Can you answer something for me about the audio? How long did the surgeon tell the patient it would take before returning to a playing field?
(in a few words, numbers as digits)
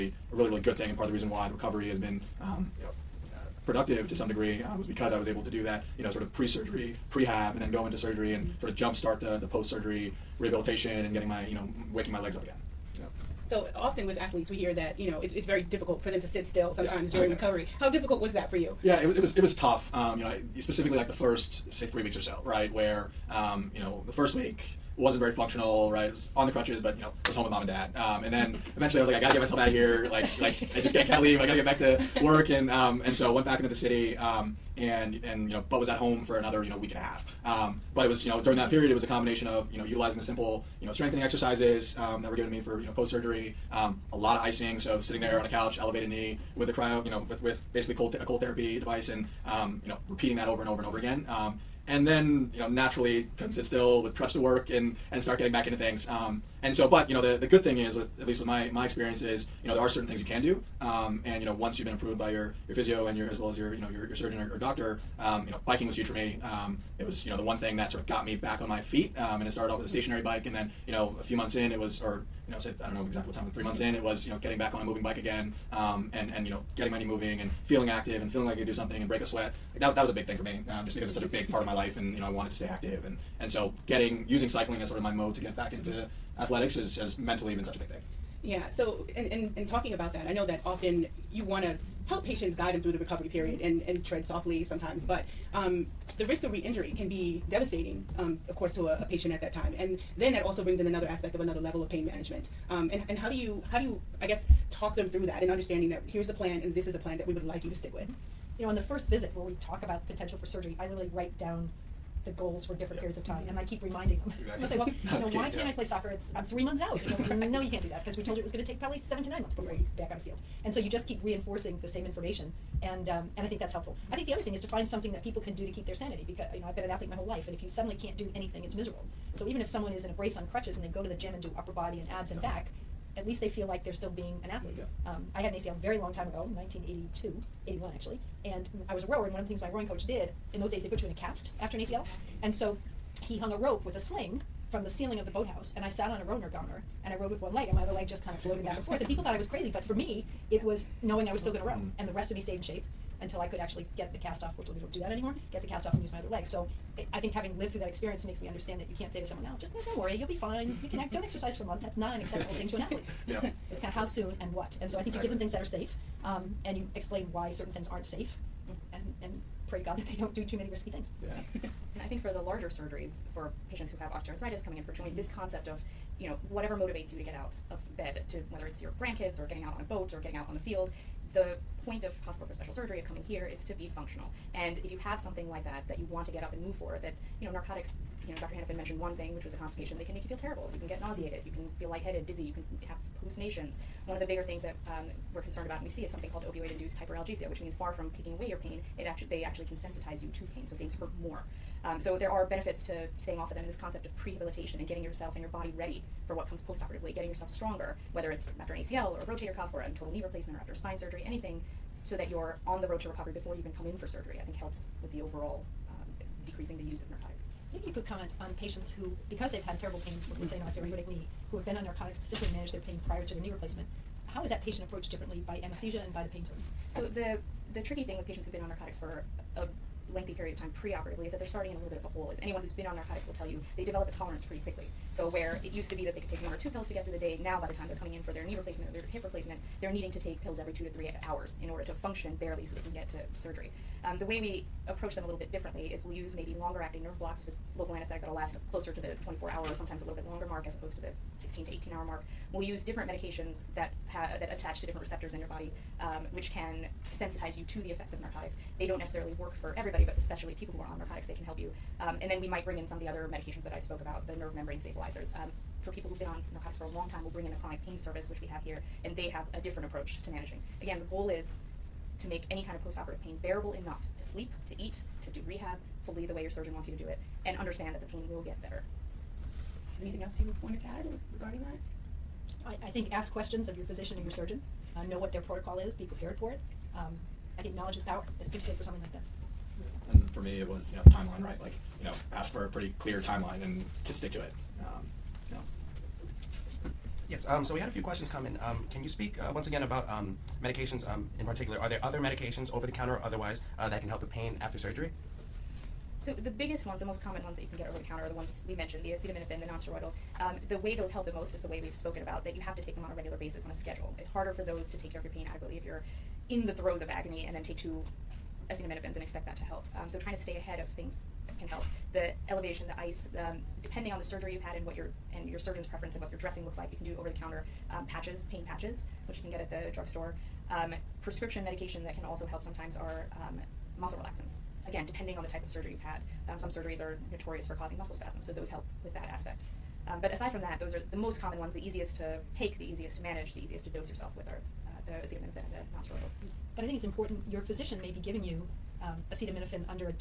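7 to 9 months.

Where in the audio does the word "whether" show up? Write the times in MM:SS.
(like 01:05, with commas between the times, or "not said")
02:58, 03:28.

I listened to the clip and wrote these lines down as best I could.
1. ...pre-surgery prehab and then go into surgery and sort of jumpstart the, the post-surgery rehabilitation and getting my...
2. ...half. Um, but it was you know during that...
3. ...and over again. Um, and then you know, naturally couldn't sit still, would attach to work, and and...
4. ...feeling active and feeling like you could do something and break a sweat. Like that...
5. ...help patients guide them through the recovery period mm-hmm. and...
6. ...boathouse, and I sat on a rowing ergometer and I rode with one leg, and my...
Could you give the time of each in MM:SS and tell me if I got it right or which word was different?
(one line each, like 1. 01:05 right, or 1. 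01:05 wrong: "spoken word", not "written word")
1. 00:06 right
2. 00:36 right
3. 00:50 wrong: "crutch", not "attach"
4. 01:17 right
5. 01:32 right
6. 02:25 right.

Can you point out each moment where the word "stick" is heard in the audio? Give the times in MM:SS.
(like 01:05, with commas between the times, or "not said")
01:47, 04:54.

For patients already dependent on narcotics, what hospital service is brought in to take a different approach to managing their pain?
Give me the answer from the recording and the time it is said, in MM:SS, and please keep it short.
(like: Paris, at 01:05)
chronic pain service, at 04:27.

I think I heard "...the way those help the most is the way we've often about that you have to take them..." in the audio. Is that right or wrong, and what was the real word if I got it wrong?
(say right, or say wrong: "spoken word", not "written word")
wrong: "spoken", not "often".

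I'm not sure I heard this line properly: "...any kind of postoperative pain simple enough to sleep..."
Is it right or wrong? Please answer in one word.
wrong.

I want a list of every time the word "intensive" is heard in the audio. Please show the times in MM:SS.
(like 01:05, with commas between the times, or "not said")
not said.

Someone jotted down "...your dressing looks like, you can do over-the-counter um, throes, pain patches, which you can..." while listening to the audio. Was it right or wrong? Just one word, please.
wrong.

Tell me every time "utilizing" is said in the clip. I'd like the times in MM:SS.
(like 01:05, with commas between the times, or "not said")
00:39.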